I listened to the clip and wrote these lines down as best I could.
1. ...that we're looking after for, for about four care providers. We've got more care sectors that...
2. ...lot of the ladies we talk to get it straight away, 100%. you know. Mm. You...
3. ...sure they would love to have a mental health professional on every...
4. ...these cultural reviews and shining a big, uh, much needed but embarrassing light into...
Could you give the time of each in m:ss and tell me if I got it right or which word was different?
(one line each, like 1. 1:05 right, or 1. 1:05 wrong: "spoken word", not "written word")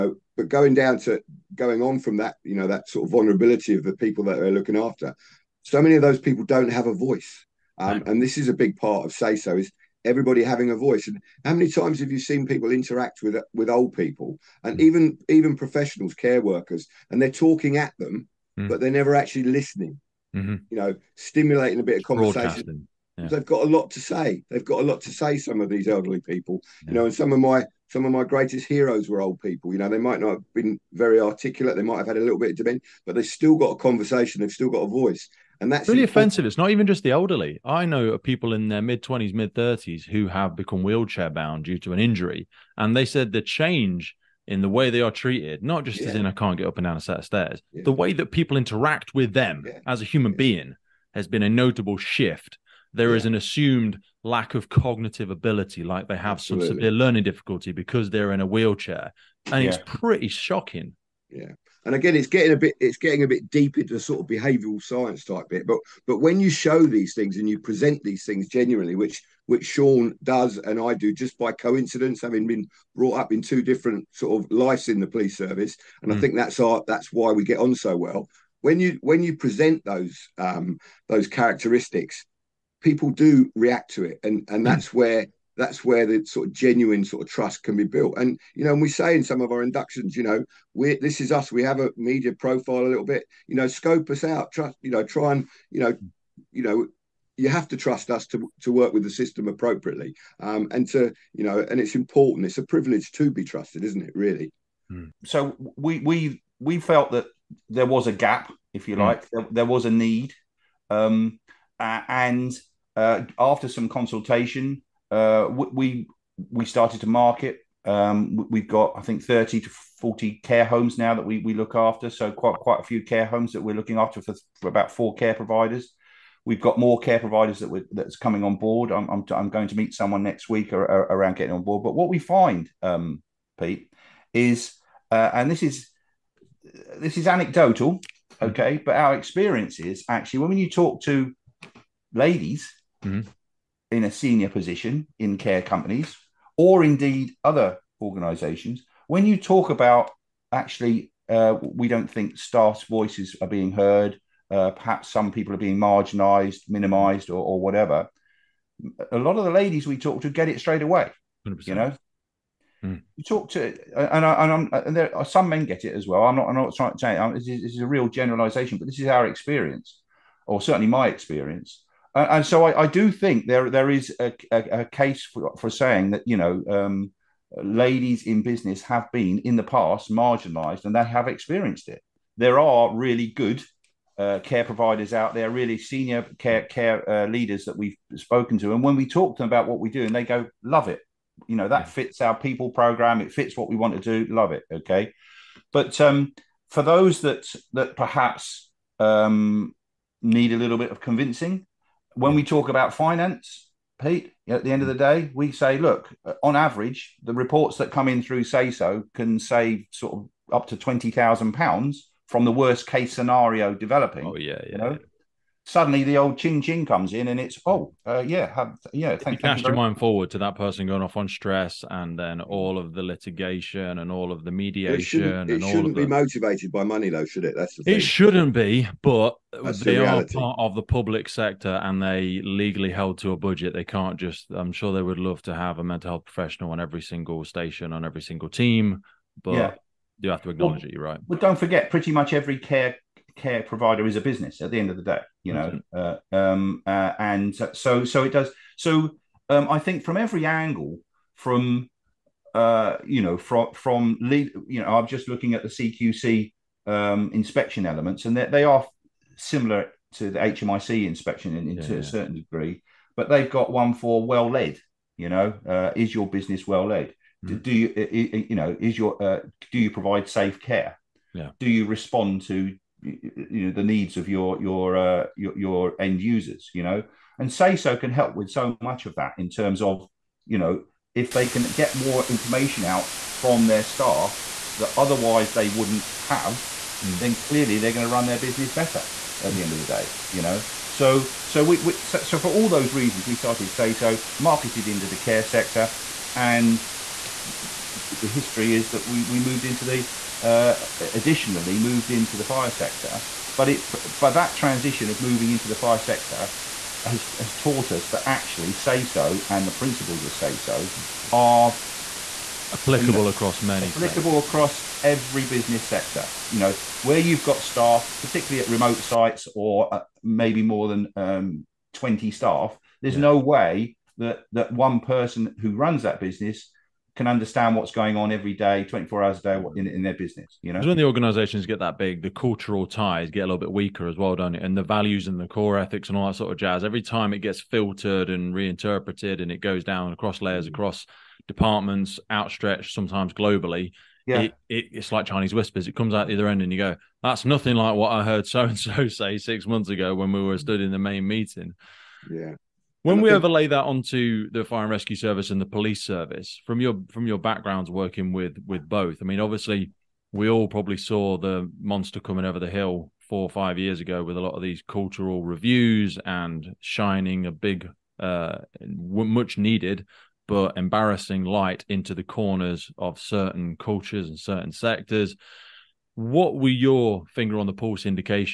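1. 2:03 wrong: "providers", not "sectors"
2. 2:39 right
3. 3:54 right
4. 6:04 right.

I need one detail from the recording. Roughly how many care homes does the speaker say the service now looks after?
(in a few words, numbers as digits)
30 to 40.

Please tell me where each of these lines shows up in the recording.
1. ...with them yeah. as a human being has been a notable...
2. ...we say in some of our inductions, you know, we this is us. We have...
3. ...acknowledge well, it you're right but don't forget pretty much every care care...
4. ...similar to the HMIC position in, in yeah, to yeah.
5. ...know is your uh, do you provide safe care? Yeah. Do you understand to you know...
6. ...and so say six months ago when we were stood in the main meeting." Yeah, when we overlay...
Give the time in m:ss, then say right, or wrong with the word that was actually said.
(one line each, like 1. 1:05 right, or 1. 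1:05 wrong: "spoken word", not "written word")
1. 0:49 right
2. 1:28 right
3. 4:00 right
4. 4:19 wrong: "inspection", not "position"
5. 4:28 wrong: "respond", not "understand"
6. 5:48 right.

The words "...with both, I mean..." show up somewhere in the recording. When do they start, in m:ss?
5:58.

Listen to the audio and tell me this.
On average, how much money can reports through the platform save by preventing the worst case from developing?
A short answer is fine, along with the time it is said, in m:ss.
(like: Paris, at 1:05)
£20,000, at 3:30.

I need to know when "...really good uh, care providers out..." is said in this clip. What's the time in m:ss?
3:02.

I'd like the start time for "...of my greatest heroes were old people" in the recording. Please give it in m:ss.
0:28.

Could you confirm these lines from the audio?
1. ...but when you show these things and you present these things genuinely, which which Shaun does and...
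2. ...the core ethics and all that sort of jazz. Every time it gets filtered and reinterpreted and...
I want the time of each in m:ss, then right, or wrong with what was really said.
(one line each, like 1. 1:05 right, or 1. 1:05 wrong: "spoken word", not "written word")
1. 1:06 right
2. 5:35 right.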